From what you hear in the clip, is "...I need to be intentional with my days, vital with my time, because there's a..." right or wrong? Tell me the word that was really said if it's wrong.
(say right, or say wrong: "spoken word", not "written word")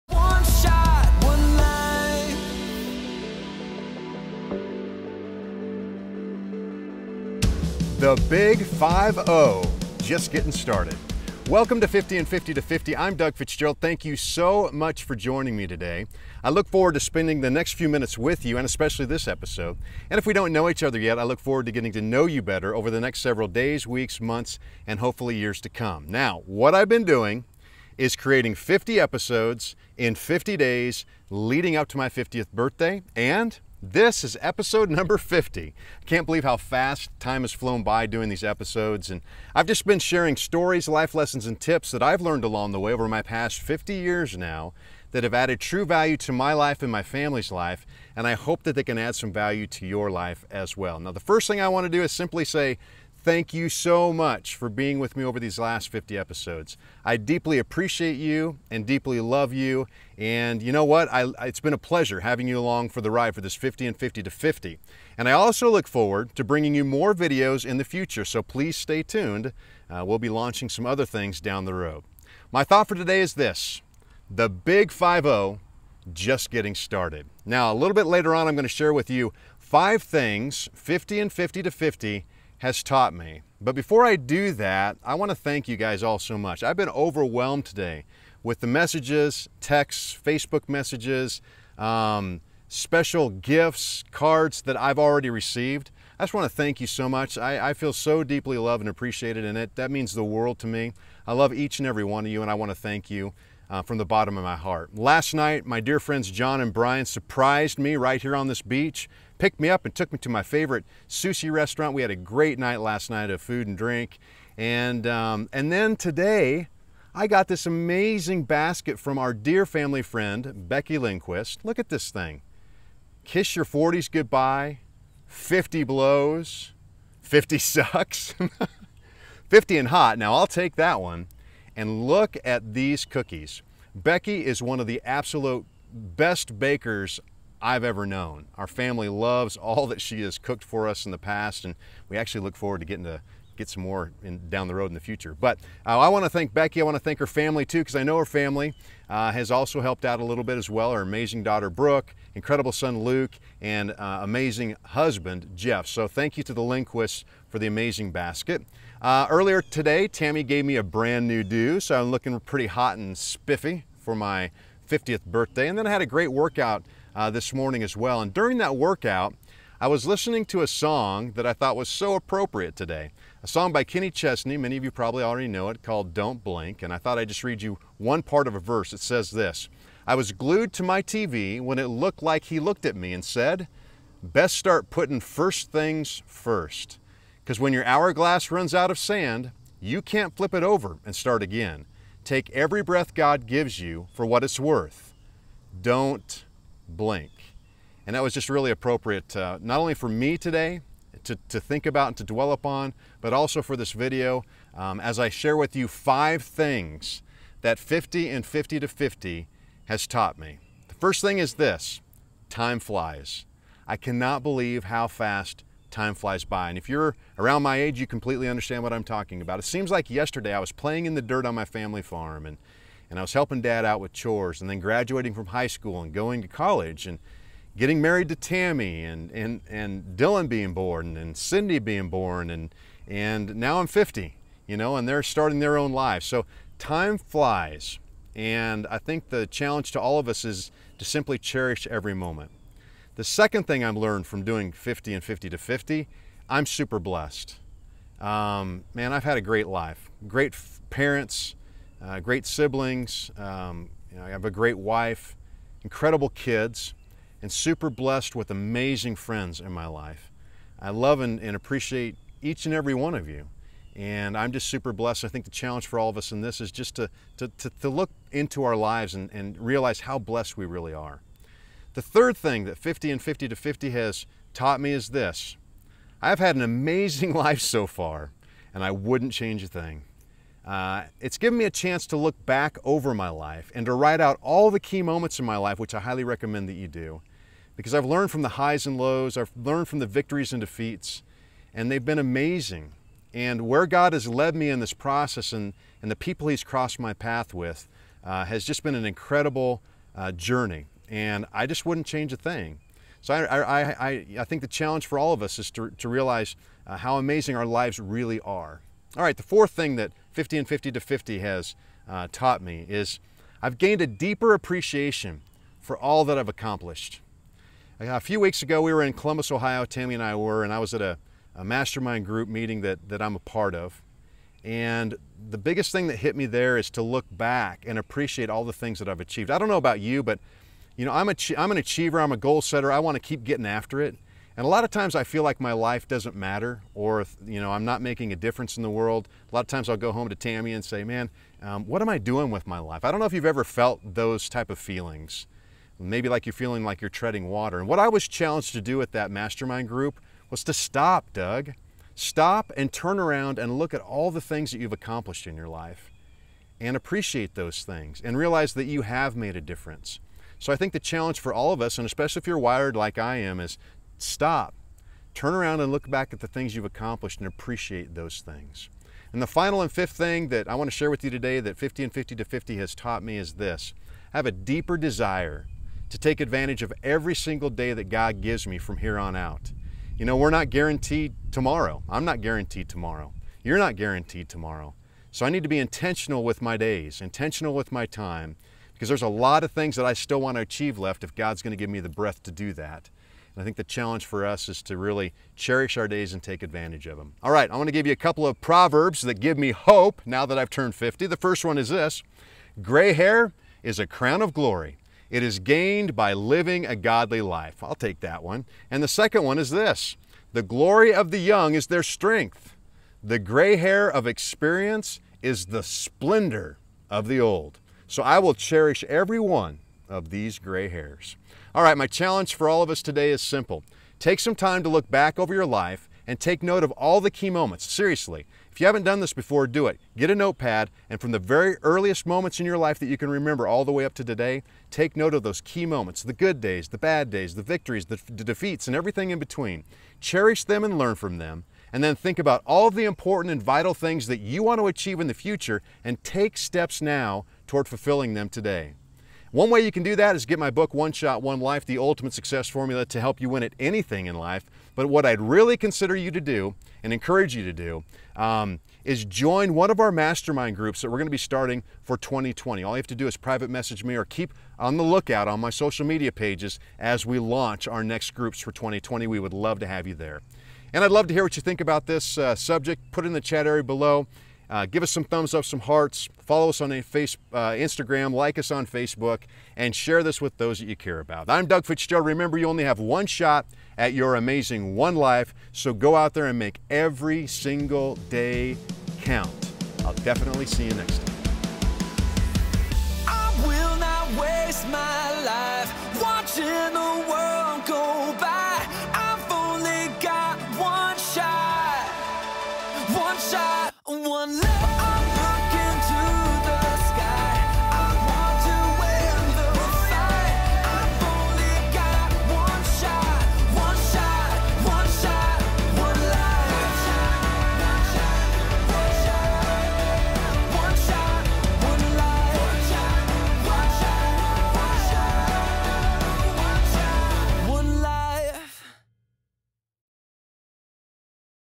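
wrong: "intentional", not "vital".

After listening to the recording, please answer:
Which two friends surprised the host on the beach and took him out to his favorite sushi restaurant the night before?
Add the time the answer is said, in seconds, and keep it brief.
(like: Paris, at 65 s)
John and Brian, at 106 s.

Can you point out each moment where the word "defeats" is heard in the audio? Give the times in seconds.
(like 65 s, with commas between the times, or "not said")
290 s, 438 s.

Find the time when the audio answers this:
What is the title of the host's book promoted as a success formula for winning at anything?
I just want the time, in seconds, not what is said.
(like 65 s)
450 s.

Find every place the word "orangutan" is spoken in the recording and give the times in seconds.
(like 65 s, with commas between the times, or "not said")
not said.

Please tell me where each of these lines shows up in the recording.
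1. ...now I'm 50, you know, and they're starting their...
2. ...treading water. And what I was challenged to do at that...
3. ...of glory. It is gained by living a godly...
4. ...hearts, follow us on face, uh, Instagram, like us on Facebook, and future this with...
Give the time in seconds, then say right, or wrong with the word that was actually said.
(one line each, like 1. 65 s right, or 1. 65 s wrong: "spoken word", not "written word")
1. 233 s right
2. 347 s right
3. 404 s right
4. 475 s wrong: "share", not "future".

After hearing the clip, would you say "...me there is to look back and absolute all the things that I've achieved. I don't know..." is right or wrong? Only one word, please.
wrong.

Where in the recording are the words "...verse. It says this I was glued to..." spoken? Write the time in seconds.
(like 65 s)
178 s.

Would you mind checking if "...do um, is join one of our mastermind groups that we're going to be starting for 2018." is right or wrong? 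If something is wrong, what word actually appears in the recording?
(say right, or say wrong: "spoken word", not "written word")
wrong: "2020", not "2018".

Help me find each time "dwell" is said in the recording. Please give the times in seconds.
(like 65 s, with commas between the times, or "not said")
202 s.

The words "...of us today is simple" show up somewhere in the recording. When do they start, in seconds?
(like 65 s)
422 s.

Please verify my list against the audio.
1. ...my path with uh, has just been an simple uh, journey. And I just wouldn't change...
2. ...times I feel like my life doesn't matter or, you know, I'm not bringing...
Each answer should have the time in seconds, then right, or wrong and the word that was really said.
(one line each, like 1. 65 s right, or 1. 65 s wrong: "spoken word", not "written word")
1. 296 s wrong: "incredible", not "simple"
2. 334 s wrong: "making", not "bringing".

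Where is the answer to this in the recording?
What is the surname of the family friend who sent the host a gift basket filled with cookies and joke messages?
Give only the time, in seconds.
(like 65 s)
120 s.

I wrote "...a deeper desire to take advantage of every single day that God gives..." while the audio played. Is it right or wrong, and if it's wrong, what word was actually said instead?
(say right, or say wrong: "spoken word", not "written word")
right.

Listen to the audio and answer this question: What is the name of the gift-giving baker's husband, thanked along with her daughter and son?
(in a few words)
Jeff.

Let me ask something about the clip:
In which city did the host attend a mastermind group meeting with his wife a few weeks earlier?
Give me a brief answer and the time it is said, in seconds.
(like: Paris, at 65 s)
Columbus, Ohio, at 319 s.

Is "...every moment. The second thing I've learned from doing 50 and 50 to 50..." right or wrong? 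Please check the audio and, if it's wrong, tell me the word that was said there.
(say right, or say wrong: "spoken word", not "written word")
right.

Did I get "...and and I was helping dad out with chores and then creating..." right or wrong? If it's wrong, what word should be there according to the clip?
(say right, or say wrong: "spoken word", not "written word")
wrong: "graduating", not "creating".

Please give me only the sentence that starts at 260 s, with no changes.
I love and, and appreciate each and every one of you.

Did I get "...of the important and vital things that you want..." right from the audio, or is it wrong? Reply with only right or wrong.
right.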